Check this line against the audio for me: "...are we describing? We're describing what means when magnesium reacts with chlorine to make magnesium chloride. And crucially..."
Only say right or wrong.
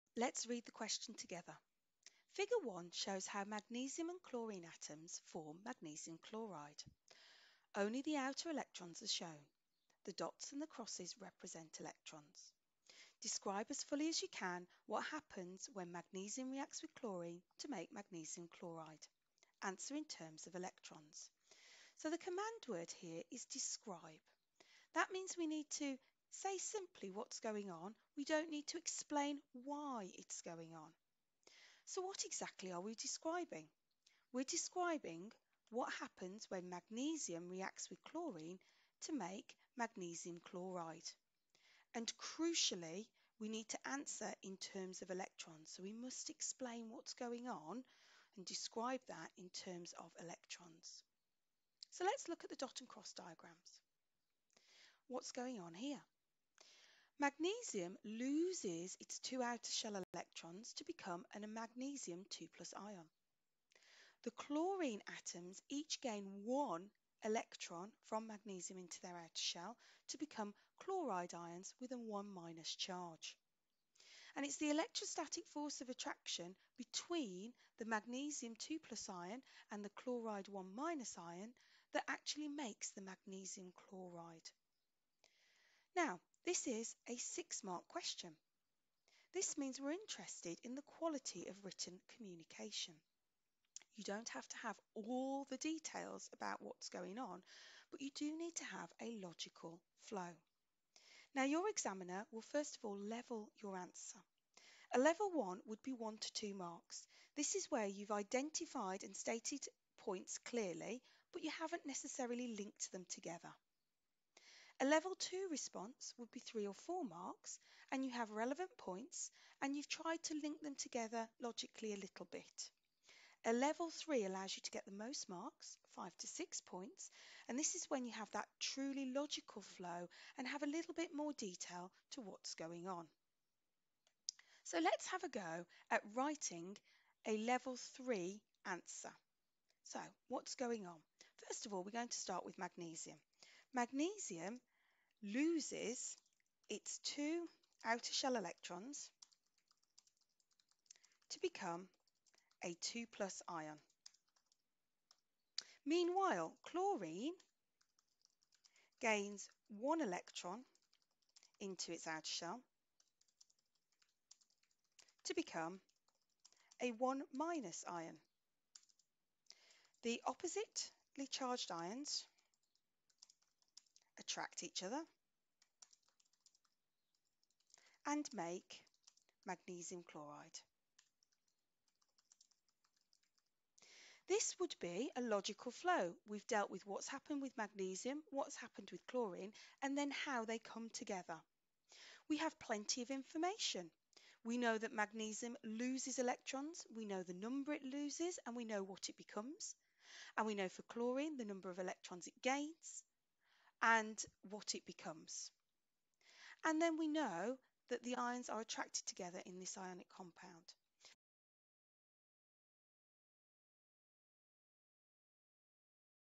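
wrong.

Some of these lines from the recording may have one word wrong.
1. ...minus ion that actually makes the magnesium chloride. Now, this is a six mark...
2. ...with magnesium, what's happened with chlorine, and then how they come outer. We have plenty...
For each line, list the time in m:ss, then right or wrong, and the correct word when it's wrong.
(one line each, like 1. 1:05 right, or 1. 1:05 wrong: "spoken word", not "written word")
1. 1:20 right
2. 3:07 wrong: "together", not "outer".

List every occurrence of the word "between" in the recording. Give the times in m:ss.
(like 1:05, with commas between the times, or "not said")
1:16.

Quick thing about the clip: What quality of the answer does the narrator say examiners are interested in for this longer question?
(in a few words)
quality of written communication.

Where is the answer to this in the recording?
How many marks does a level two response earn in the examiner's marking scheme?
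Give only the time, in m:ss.
1:56.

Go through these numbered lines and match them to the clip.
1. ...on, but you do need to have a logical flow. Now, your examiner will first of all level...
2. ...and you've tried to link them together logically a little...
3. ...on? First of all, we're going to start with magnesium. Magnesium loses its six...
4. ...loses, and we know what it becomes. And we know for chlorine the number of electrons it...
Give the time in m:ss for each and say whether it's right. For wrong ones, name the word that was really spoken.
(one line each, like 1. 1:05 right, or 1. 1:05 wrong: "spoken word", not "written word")
1. 1:37 right
2. 1:59 right
3. 2:20 wrong: "two", not "six"
4. 3:17 right.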